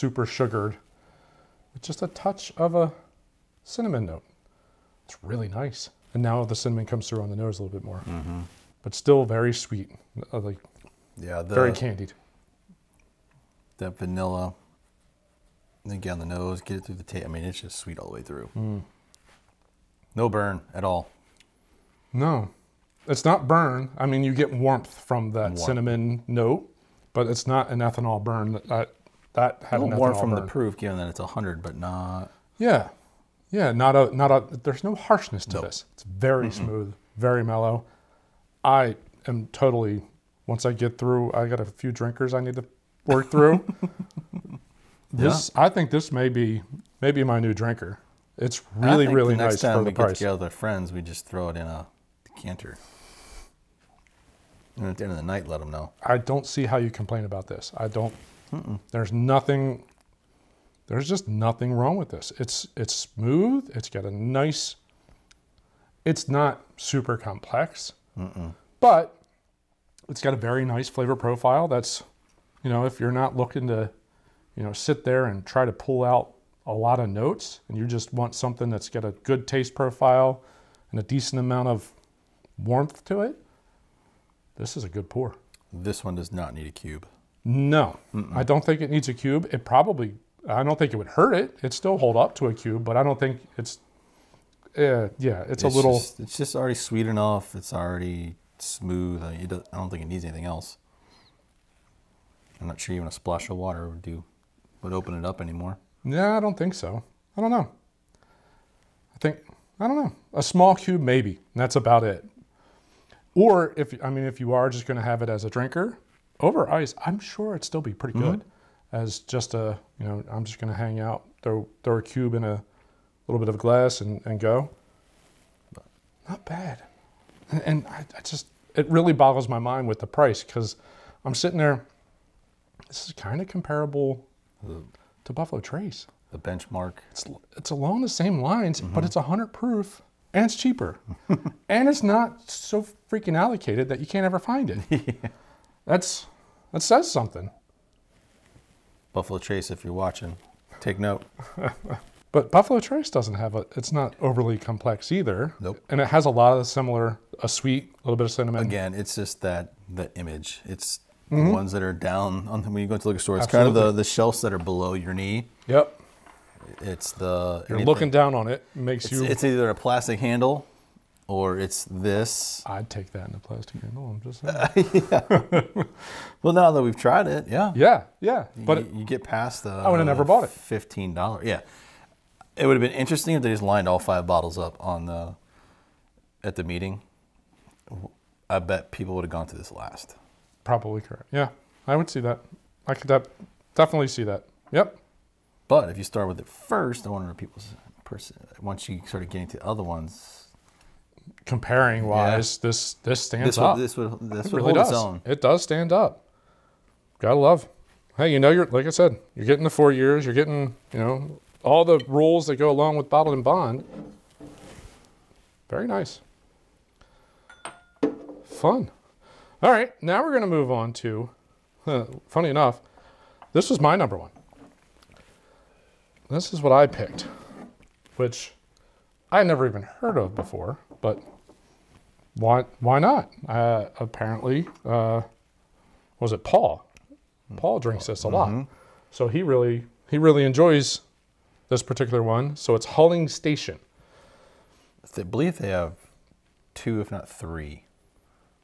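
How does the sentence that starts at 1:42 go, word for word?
I'm not sure even a splash of water would do would open it up anymore.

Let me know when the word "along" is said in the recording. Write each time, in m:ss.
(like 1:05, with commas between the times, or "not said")
2:17, 3:32.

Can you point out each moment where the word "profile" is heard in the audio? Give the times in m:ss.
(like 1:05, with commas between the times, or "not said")
1:11, 1:19.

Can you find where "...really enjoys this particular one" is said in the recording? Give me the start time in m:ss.
4:00.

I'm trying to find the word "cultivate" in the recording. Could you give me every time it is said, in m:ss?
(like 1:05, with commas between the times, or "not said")
not said.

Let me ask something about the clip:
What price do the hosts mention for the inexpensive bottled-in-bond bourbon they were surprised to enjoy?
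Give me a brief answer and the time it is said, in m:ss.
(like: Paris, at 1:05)
$15, at 3:00.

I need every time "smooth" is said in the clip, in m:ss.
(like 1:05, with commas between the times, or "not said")
0:36, 1:02, 1:38.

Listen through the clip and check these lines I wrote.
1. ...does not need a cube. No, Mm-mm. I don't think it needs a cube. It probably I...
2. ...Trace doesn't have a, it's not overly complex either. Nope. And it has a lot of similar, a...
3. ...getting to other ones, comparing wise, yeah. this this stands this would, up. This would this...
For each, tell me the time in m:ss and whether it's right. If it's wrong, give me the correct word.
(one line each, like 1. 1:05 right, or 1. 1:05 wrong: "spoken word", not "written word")
1. 1:26 right
2. 2:32 right
3. 3:19 right.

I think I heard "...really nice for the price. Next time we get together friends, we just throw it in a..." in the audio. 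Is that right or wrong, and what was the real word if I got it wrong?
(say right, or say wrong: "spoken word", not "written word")
right.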